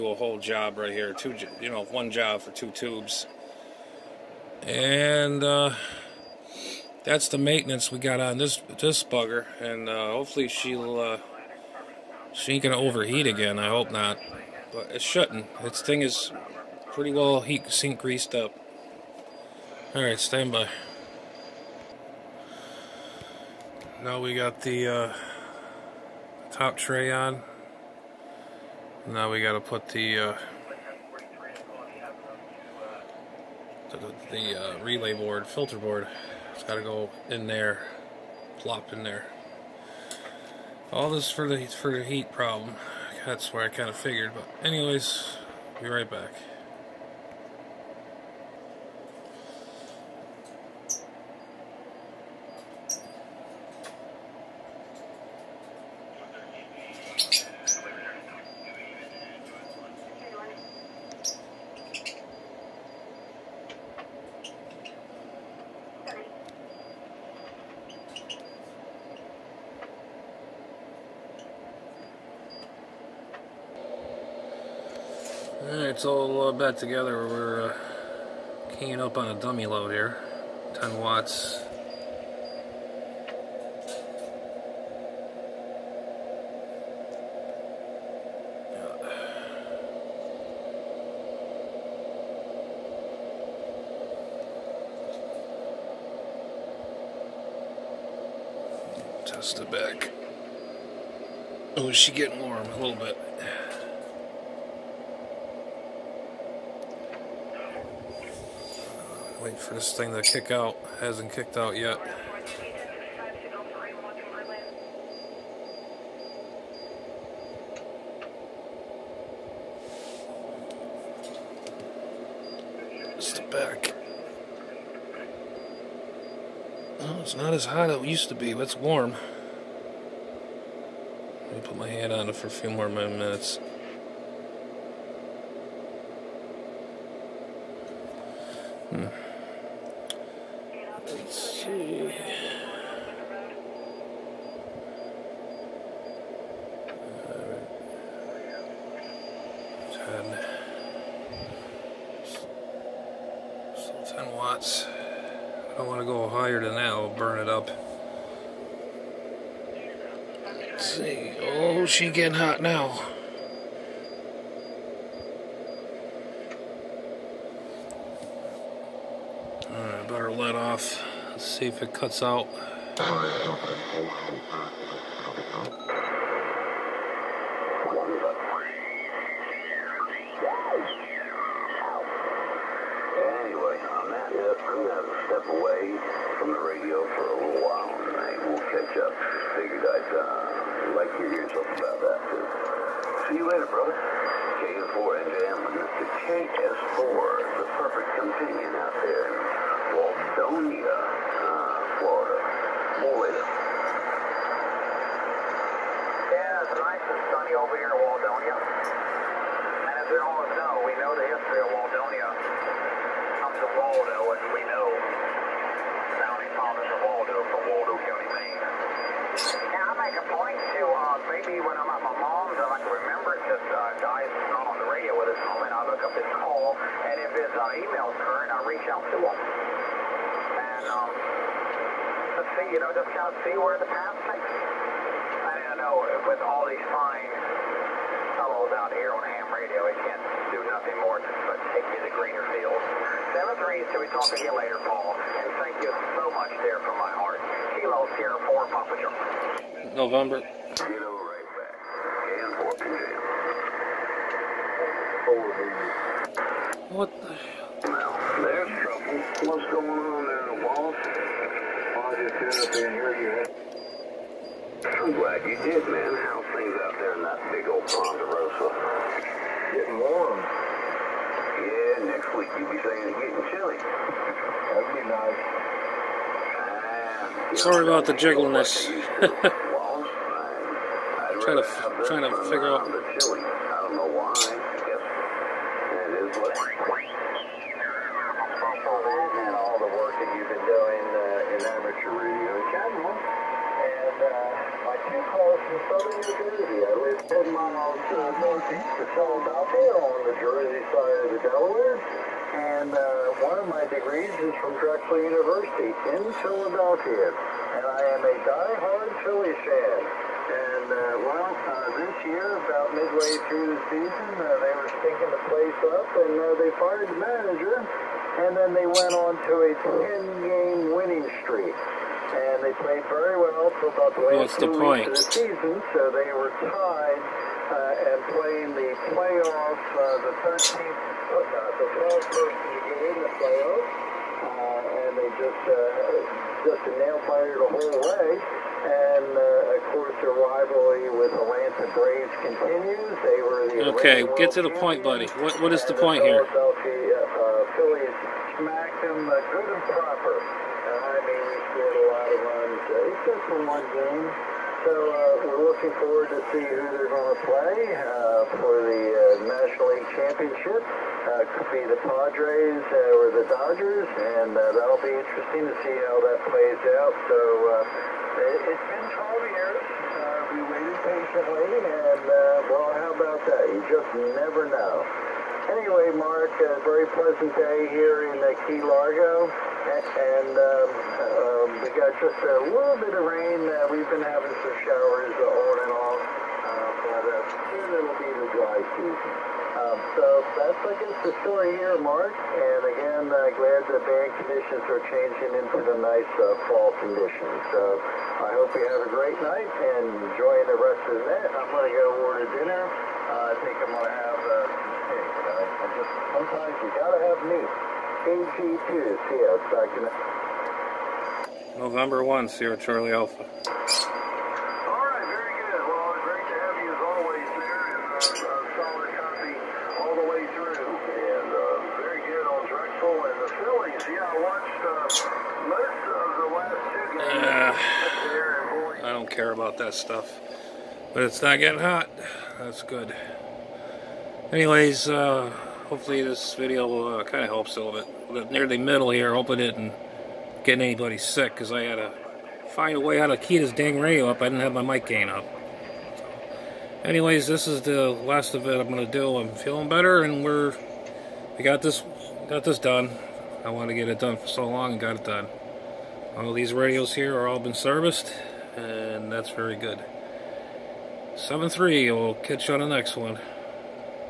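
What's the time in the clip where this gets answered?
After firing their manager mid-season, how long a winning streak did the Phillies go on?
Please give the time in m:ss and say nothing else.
5:19.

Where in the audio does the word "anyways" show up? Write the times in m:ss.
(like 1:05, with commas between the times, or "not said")
0:44, 6:15, 7:14, 7:27.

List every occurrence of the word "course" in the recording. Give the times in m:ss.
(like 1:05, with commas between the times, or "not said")
5:39.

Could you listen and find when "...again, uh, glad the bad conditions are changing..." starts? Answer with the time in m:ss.
6:32.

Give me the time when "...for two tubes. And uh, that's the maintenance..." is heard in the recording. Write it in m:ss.
0:02.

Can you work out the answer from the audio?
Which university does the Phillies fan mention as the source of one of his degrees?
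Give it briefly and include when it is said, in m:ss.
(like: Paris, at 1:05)
Drexel University, at 5:04.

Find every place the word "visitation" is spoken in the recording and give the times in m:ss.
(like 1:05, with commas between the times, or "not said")
not said.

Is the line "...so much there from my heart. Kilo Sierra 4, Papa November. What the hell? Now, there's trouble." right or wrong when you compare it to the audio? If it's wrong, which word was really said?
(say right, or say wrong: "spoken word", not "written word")
right.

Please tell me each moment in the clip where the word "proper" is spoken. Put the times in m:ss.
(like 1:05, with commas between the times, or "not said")
5:49.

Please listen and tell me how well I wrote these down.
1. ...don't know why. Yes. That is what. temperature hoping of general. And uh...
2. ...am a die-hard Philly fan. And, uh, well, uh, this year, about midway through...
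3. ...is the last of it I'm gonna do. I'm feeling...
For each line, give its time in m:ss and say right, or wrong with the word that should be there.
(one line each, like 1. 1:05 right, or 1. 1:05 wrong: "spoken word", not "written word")
1. 4:43 wrong: "reading", not "hoping"
2. 5:08 right
3. 7:27 right.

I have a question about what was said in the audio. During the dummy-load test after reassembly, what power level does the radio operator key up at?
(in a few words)
10 watts.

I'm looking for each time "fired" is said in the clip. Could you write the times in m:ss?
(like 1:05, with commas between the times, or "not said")
5:16, 5:37.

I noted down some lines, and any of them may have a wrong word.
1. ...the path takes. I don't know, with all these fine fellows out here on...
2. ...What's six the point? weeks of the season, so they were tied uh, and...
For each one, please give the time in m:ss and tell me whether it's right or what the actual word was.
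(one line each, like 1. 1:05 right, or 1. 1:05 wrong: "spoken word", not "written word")
1. 3:53 right
2. 5:24 wrong: "two", not "six".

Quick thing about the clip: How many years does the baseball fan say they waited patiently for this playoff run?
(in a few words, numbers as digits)
12.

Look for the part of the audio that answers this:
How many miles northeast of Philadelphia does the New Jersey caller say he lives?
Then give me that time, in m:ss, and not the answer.
4:57.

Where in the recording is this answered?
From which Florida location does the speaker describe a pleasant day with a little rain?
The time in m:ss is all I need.
6:18.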